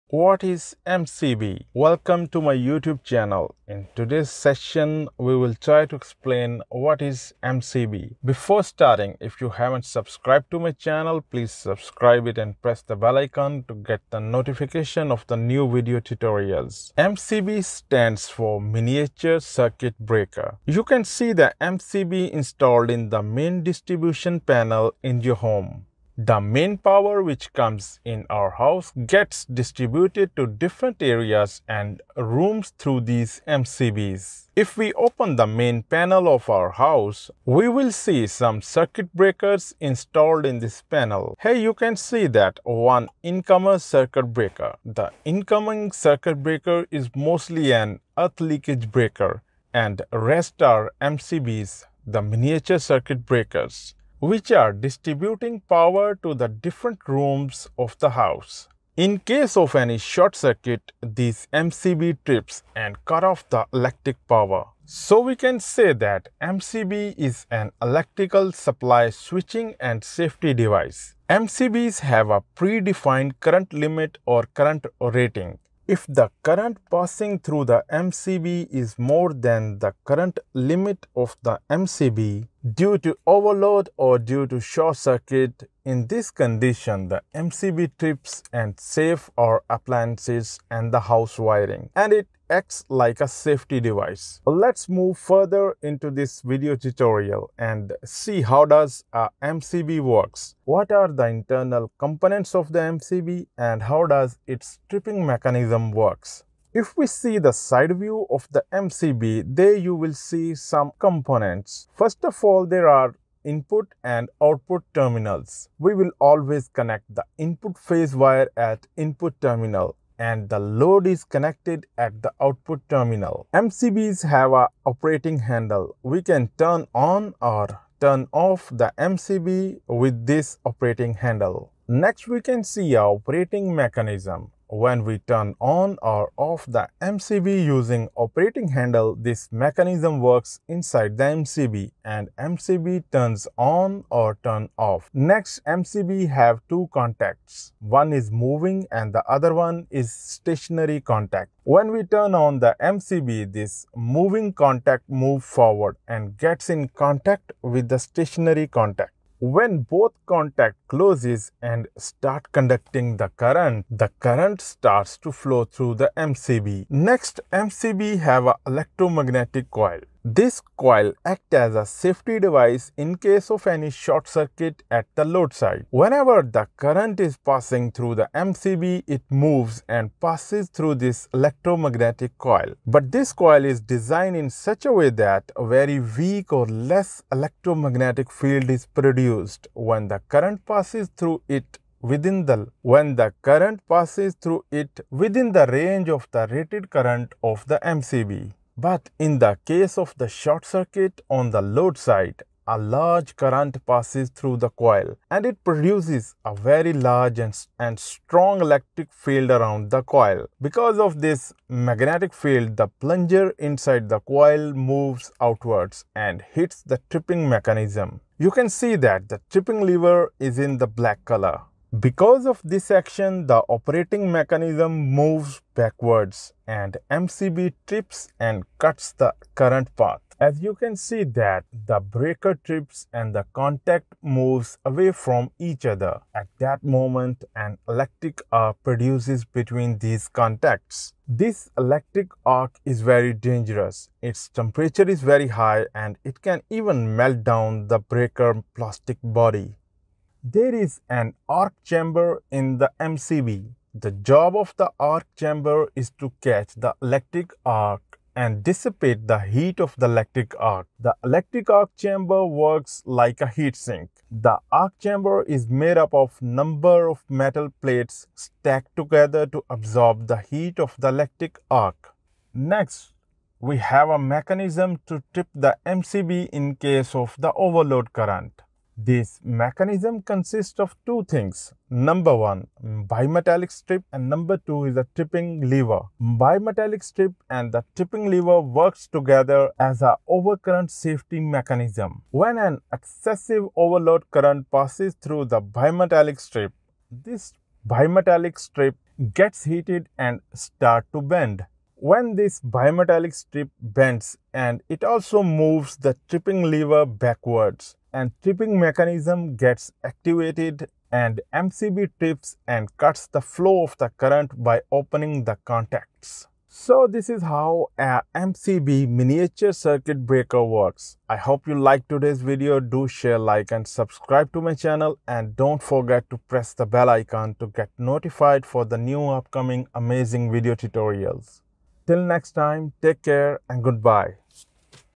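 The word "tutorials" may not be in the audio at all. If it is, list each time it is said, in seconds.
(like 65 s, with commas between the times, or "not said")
16 s, 96 s, 330 s.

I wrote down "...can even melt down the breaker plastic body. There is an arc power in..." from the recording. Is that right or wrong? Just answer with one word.
wrong.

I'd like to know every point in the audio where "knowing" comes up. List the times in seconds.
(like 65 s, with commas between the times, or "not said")
not said.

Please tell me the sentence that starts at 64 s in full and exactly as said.
So we can say that MCB is an electrical supply switching and safety device.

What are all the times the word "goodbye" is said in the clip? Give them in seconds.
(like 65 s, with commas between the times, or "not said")
333 s.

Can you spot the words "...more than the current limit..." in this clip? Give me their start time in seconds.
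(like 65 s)
78 s.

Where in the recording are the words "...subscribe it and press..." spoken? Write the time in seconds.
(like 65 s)
11 s.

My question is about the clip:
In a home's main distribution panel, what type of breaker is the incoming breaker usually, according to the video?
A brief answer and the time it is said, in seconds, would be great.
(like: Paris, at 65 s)
earth leakage breaker, at 48 s.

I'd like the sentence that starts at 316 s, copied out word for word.
So this is how a MCB miniature circuit breaker works.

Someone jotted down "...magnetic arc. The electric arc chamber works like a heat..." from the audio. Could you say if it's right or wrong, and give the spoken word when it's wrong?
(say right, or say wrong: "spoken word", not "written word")
wrong: "electric", not "magnetic".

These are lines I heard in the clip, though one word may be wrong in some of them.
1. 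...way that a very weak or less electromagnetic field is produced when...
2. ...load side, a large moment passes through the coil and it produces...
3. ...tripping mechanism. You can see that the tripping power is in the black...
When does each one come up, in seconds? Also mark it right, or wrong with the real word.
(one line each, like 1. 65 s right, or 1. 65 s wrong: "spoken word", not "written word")
1. 184 s right
2. 201 s wrong: "current", not "moment"
3. 217 s wrong: "lever", not "power".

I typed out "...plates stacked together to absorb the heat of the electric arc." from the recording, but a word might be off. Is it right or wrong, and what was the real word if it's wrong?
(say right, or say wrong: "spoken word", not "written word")
right.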